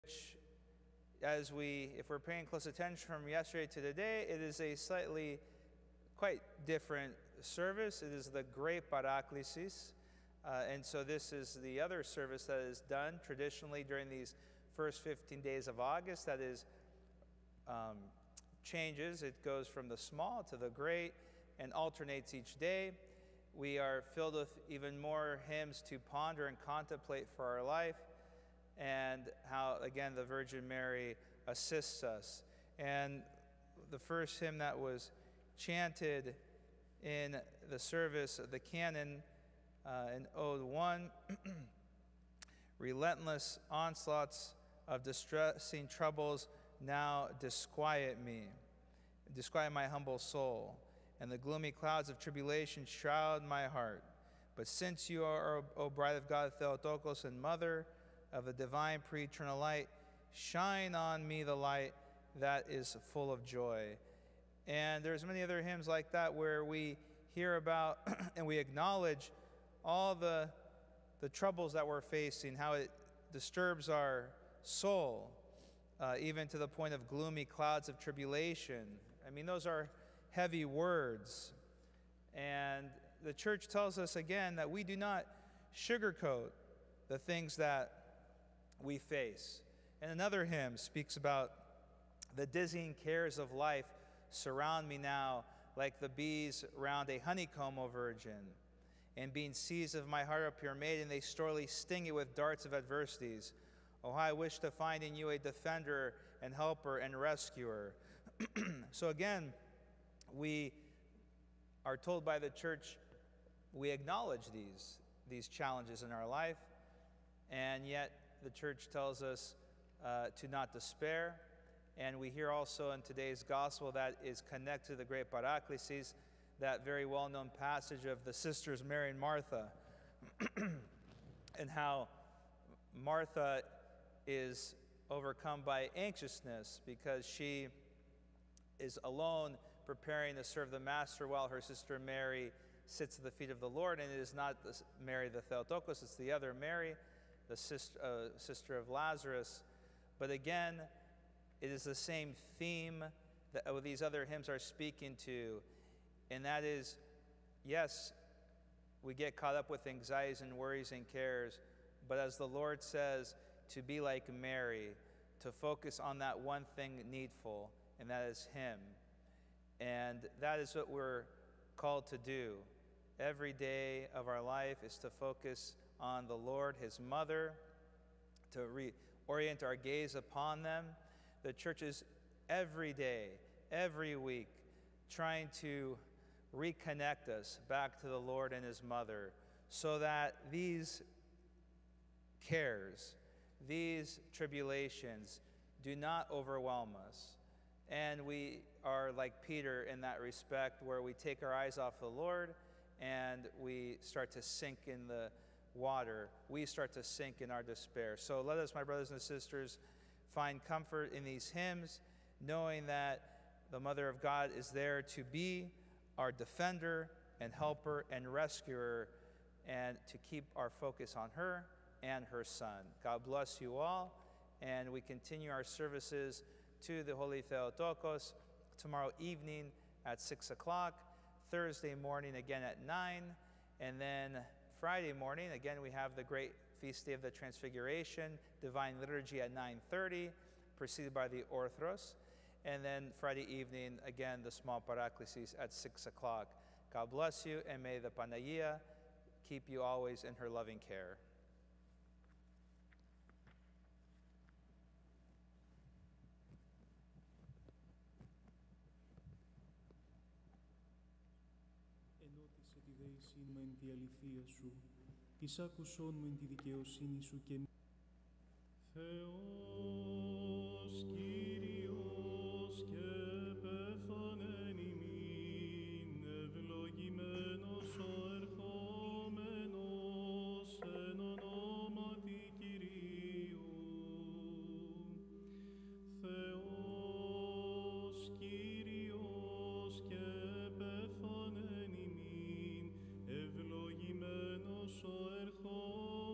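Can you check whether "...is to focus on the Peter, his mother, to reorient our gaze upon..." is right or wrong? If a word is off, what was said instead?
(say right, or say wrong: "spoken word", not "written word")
wrong: "Lord", not "Peter".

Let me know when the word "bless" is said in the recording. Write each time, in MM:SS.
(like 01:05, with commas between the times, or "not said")
03:43, 04:07.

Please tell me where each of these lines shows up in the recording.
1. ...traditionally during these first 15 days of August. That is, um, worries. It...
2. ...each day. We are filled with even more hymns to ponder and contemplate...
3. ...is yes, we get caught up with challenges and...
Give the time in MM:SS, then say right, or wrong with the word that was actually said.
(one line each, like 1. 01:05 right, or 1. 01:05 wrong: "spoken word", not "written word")
1. 00:13 wrong: "changes", not "worries"
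2. 00:22 right
3. 02:36 wrong: "anxieties", not "challenges".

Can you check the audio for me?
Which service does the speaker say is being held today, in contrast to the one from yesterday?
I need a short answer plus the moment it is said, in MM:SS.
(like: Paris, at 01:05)
Great Paraklesis, at 00:08.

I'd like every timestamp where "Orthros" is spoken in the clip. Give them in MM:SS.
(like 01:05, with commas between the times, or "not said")
04:01.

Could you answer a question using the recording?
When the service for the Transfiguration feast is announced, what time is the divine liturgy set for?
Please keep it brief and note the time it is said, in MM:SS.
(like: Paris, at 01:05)
9:30, at 03:59.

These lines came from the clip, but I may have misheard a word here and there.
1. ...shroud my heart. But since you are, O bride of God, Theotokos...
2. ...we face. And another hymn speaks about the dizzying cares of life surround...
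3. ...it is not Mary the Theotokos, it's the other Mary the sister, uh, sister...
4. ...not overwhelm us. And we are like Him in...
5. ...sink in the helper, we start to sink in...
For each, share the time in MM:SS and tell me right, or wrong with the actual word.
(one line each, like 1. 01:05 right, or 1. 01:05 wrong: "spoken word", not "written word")
1. 00:52 right
2. 01:28 right
3. 02:24 right
4. 03:15 wrong: "Peter", not "Him"
5. 03:24 wrong: "water", not "helper".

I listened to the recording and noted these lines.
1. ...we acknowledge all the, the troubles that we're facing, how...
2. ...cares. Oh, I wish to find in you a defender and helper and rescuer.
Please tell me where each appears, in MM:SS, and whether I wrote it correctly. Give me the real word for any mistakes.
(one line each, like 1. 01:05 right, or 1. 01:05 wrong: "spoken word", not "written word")
1. 01:08 right
2. 01:42 wrong: "adversities", not "cares".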